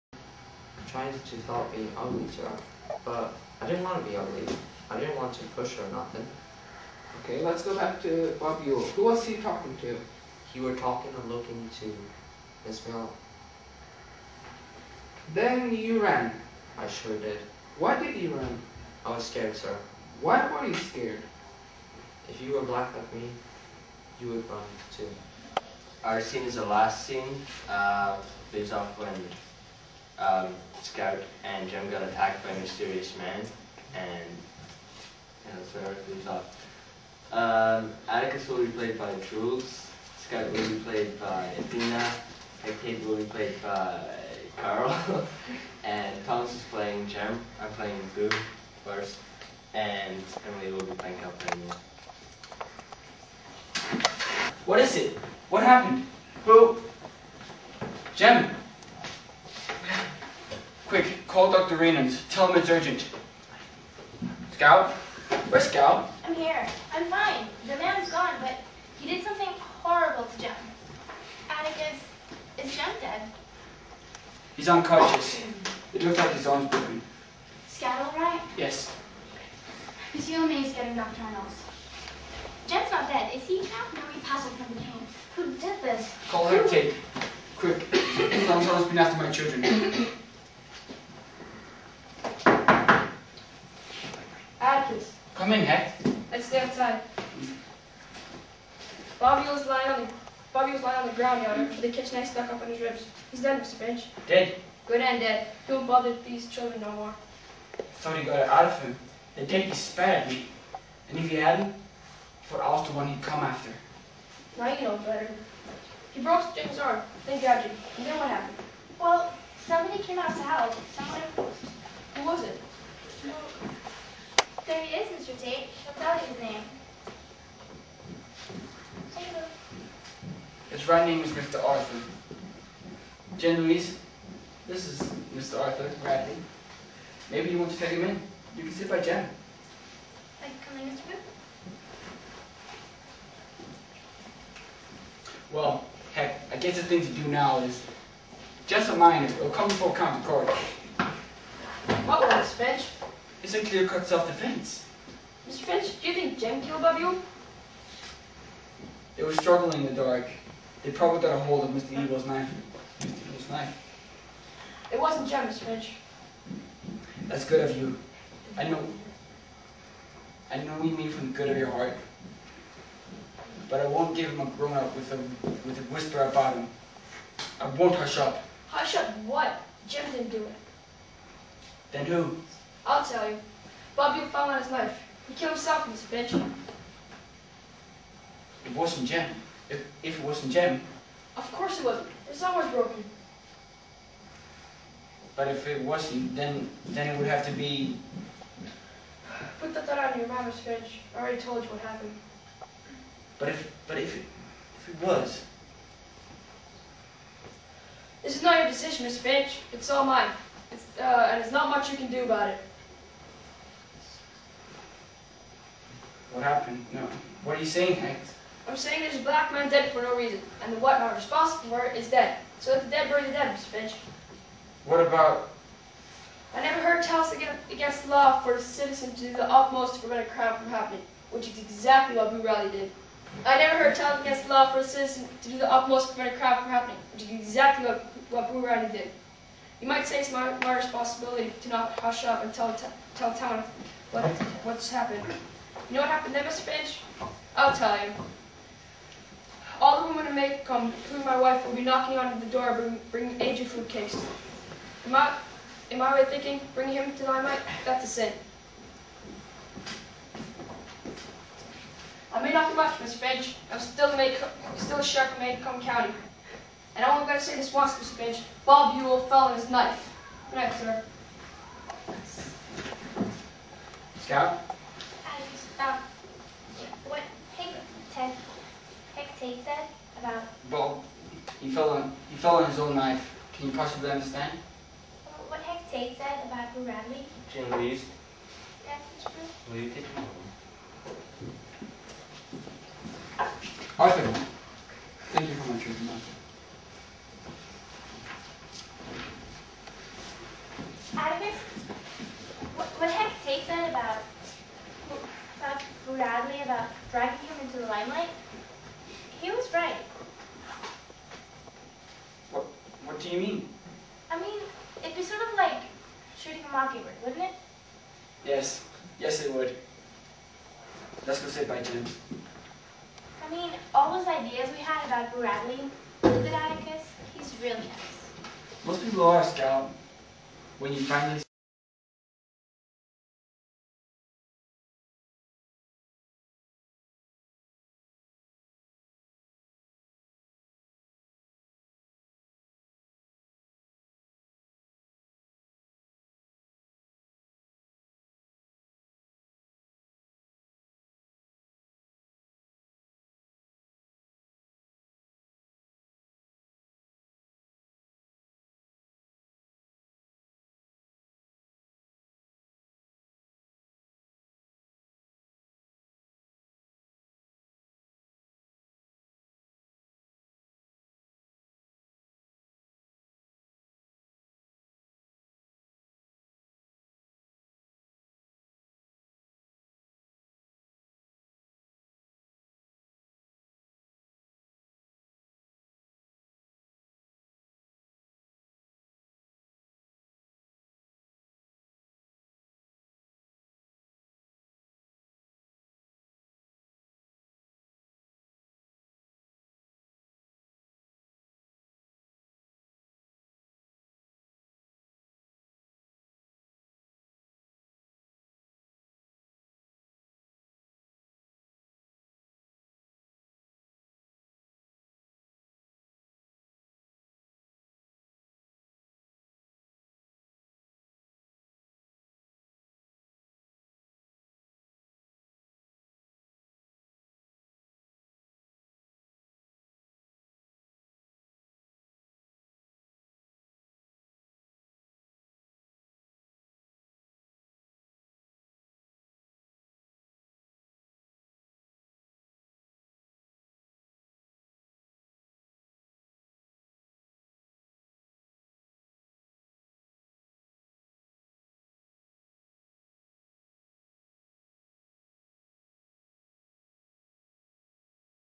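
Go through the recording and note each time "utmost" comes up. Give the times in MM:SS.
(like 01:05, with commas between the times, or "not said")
03:49, 03:55.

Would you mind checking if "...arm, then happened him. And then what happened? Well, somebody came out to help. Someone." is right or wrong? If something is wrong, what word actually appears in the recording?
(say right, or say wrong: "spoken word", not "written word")
wrong: "grabbed", not "happened".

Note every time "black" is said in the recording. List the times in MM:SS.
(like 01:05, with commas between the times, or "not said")
00:22, 03:39.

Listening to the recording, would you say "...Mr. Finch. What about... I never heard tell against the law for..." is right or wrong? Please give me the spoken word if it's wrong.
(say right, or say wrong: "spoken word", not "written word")
right.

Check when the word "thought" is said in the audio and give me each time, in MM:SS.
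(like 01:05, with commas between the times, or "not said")
01:47, 03:19.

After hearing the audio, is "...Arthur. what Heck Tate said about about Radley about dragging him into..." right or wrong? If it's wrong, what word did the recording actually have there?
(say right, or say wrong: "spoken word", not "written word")
right.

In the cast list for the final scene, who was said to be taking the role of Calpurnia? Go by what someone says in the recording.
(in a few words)
Emily.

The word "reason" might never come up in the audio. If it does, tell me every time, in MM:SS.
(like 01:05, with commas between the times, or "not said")
03:40.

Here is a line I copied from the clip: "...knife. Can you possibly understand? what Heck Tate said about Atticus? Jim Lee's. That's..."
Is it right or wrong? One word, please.
wrong.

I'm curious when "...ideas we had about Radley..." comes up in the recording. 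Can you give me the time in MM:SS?
05:24.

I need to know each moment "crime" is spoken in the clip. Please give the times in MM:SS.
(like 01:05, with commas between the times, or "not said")
03:50, 03:56.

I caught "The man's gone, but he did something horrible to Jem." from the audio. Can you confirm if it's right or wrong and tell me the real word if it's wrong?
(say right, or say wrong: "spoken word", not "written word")
right.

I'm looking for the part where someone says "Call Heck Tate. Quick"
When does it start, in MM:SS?
01:26.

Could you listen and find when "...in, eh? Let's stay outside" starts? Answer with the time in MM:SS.
01:35.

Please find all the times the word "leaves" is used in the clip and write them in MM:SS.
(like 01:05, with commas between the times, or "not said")
00:28, 00:36.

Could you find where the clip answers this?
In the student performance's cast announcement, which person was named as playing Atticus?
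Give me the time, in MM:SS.
00:39.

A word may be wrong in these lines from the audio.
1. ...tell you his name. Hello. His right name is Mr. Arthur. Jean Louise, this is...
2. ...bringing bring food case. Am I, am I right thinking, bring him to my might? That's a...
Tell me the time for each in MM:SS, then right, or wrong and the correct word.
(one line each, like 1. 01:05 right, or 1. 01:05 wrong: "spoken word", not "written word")
1. 02:06 right
2. 04:13 right.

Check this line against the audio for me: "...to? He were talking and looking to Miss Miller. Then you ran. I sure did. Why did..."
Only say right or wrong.
right.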